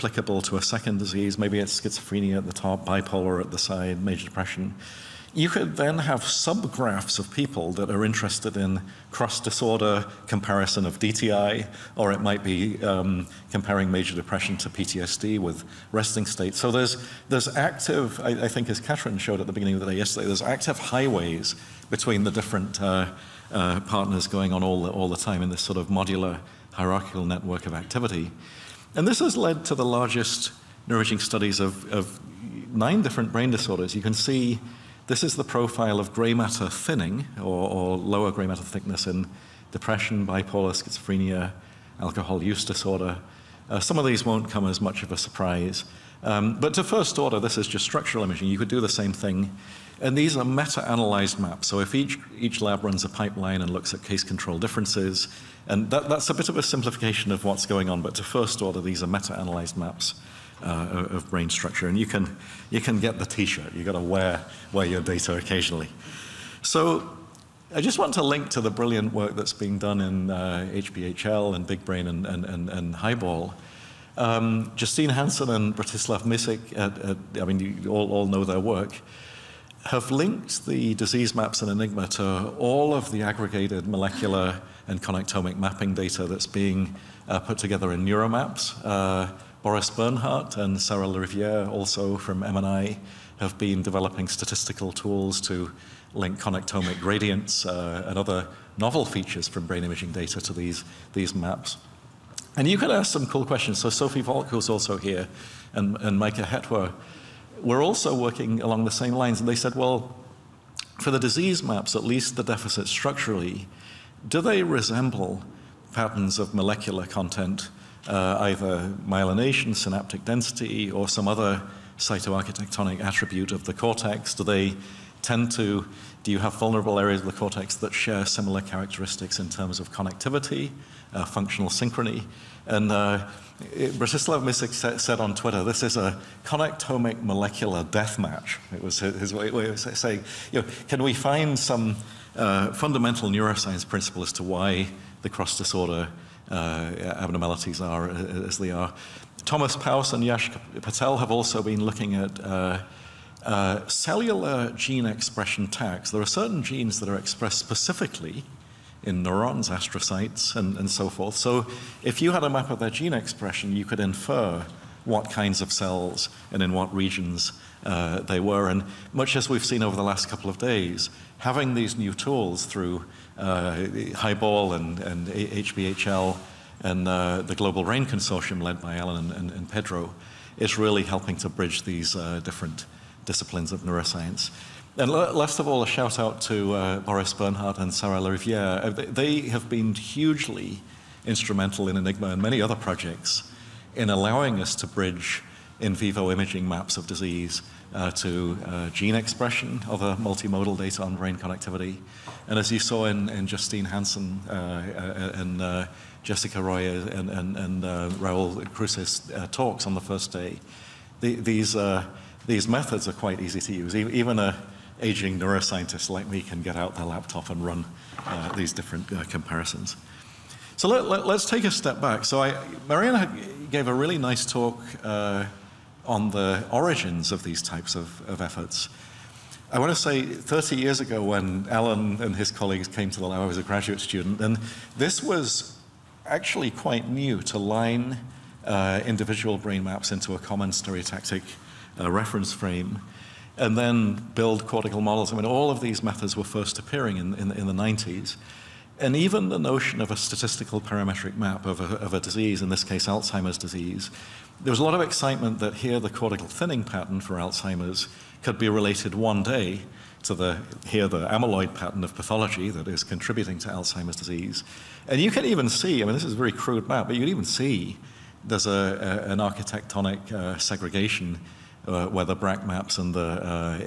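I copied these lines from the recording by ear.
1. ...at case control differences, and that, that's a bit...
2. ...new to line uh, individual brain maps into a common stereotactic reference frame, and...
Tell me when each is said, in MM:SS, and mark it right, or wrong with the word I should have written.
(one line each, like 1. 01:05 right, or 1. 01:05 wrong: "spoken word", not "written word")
1. 00:53 right
2. 03:57 right.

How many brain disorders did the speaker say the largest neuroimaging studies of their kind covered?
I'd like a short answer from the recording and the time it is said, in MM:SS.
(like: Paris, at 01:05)
9, at 00:32.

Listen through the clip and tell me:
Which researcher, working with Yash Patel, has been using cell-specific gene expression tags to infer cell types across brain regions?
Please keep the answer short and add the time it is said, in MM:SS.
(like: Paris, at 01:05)
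Thomas Paus, at 02:29.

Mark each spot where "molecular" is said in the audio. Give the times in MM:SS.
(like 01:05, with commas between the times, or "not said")
01:23, 01:56, 02:17.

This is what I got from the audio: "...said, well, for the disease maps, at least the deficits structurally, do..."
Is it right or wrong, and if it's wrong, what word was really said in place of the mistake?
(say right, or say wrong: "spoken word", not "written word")
right.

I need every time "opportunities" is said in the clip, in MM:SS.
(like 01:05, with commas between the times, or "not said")
not said.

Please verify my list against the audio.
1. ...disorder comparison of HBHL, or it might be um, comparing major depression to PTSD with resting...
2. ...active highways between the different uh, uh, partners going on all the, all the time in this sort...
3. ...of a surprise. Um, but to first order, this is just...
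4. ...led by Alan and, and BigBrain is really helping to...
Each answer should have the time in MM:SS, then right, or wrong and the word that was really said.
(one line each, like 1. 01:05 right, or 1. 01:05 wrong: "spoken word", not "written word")
1. 00:09 wrong: "DTI", not "HBHL"
2. 00:20 right
3. 00:45 right
4. 02:58 wrong: "Pedro", not "BigBrain".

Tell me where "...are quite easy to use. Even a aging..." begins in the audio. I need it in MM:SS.
03:33.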